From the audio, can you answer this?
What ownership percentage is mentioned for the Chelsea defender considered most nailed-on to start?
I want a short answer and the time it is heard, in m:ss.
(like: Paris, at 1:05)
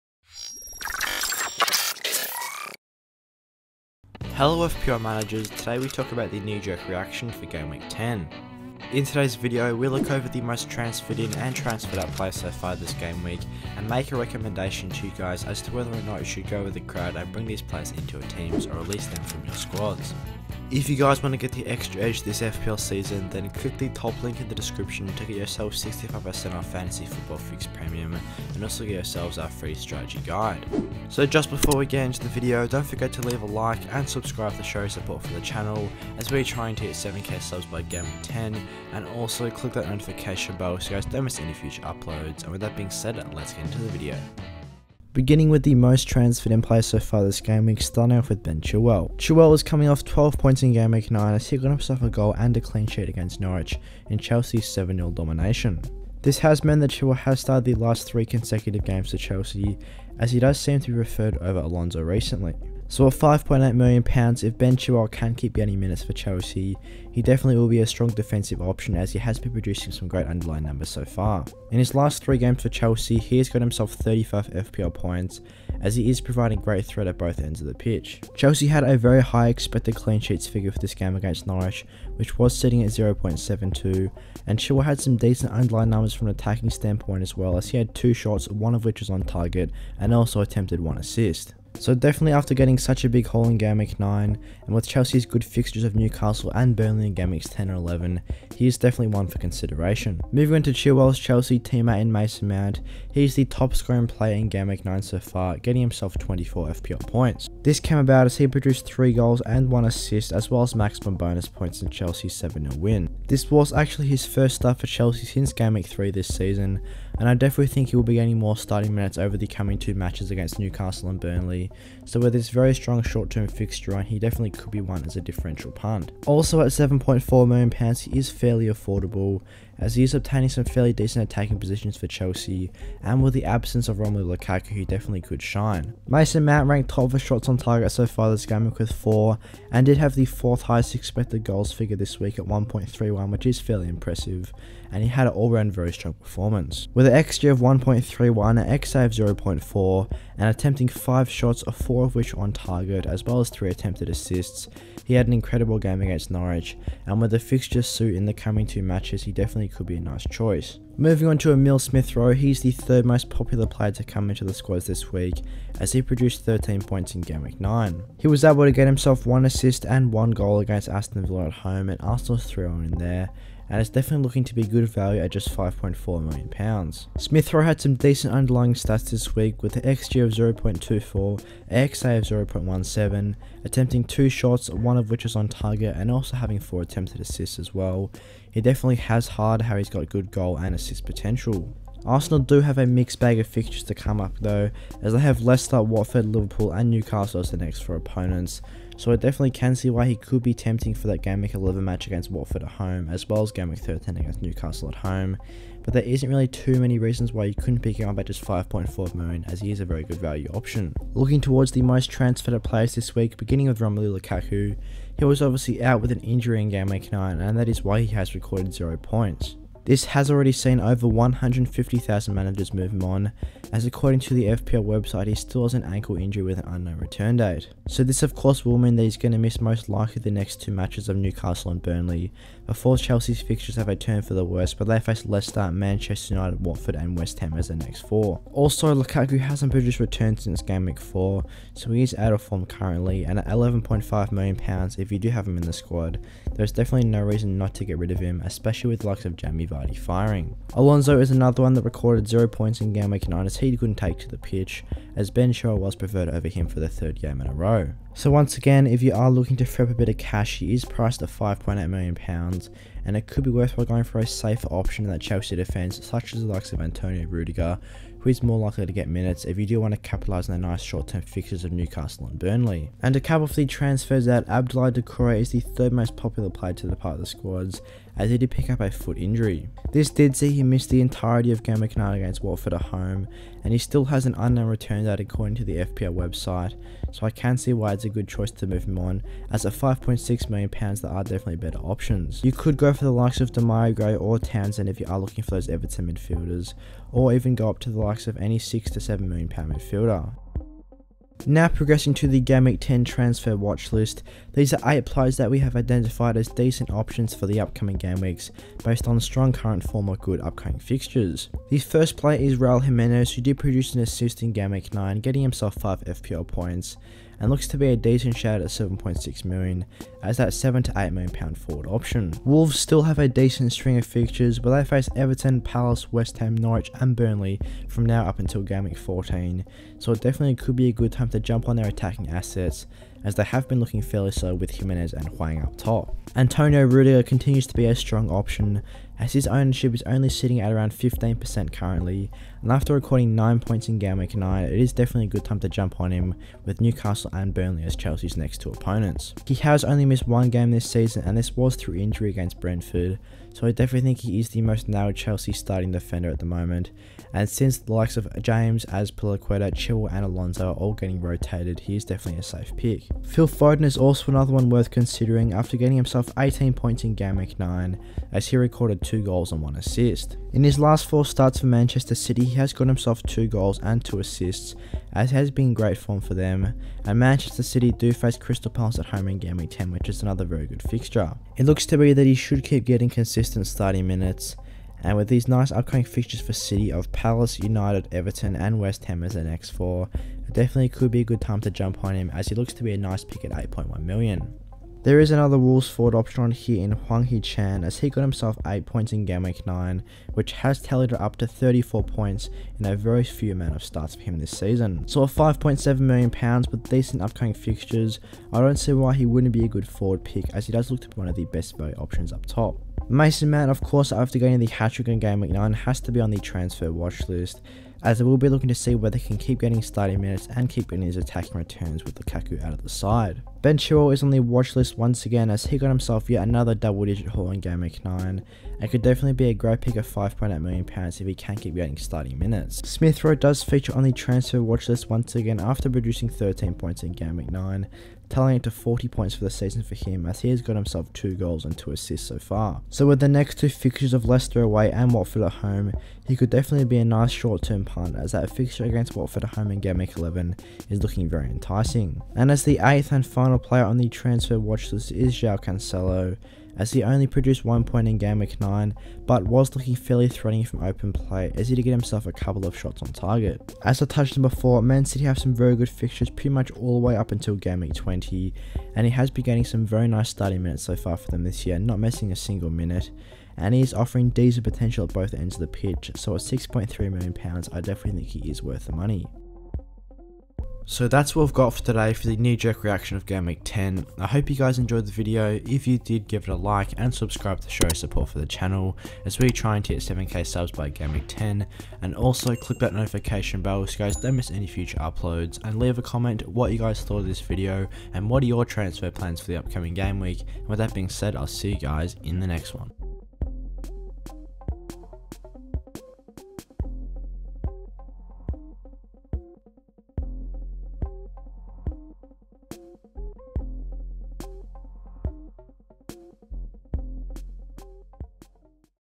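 15%, at 5:40.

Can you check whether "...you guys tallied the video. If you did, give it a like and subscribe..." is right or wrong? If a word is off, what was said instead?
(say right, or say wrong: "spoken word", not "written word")
wrong: "enjoyed", not "tallied".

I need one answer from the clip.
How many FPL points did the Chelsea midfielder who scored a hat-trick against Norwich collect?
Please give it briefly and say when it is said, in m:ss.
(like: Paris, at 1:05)
24, at 1:46.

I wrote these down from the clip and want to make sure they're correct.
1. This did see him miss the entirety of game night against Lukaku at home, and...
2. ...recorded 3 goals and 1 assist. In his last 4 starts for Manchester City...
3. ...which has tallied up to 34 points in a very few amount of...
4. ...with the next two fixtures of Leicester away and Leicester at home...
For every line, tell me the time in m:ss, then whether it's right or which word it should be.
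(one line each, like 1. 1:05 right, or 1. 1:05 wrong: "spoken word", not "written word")
1. 4:39 wrong: "Watford", not "Lukaku"
2. 6:08 wrong: "2", not "3"
3. 6:40 right
4. 7:23 wrong: "Watford", not "Leicester".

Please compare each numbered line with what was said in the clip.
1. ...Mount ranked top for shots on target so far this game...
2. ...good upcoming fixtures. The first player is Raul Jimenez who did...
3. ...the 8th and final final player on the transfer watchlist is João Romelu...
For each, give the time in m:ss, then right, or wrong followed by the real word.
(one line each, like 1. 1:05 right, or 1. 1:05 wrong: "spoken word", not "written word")
1. 2:16 right
2. 5:10 right
3. 7:32 wrong: "Cancelo", not "Romelu".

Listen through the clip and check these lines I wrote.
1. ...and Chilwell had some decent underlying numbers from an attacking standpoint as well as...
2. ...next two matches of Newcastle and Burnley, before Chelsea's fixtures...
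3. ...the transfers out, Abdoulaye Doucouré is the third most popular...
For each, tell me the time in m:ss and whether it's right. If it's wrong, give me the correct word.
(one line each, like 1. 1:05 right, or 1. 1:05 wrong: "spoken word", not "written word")
1. 1:24 right
2. 3:50 right
3. 4:33 right.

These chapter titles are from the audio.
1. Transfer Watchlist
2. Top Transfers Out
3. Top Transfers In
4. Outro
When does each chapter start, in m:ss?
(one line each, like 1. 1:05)
1. 5:02
2. 3:34
3. 0:46
4. 8:01.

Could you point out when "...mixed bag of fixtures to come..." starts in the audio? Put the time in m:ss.
3:12.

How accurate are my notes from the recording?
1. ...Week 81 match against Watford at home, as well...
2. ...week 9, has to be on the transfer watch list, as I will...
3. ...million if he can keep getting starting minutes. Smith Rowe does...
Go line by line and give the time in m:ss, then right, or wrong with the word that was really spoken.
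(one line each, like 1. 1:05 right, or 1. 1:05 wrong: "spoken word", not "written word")
1. 3:21 wrong: "11", not "81"
2. 6:55 right
3. 7:10 right.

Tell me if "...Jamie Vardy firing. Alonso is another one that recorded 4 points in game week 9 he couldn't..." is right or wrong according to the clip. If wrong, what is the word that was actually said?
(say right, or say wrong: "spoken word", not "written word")
wrong: "0", not "4".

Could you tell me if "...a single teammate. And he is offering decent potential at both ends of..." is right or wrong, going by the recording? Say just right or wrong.
wrong.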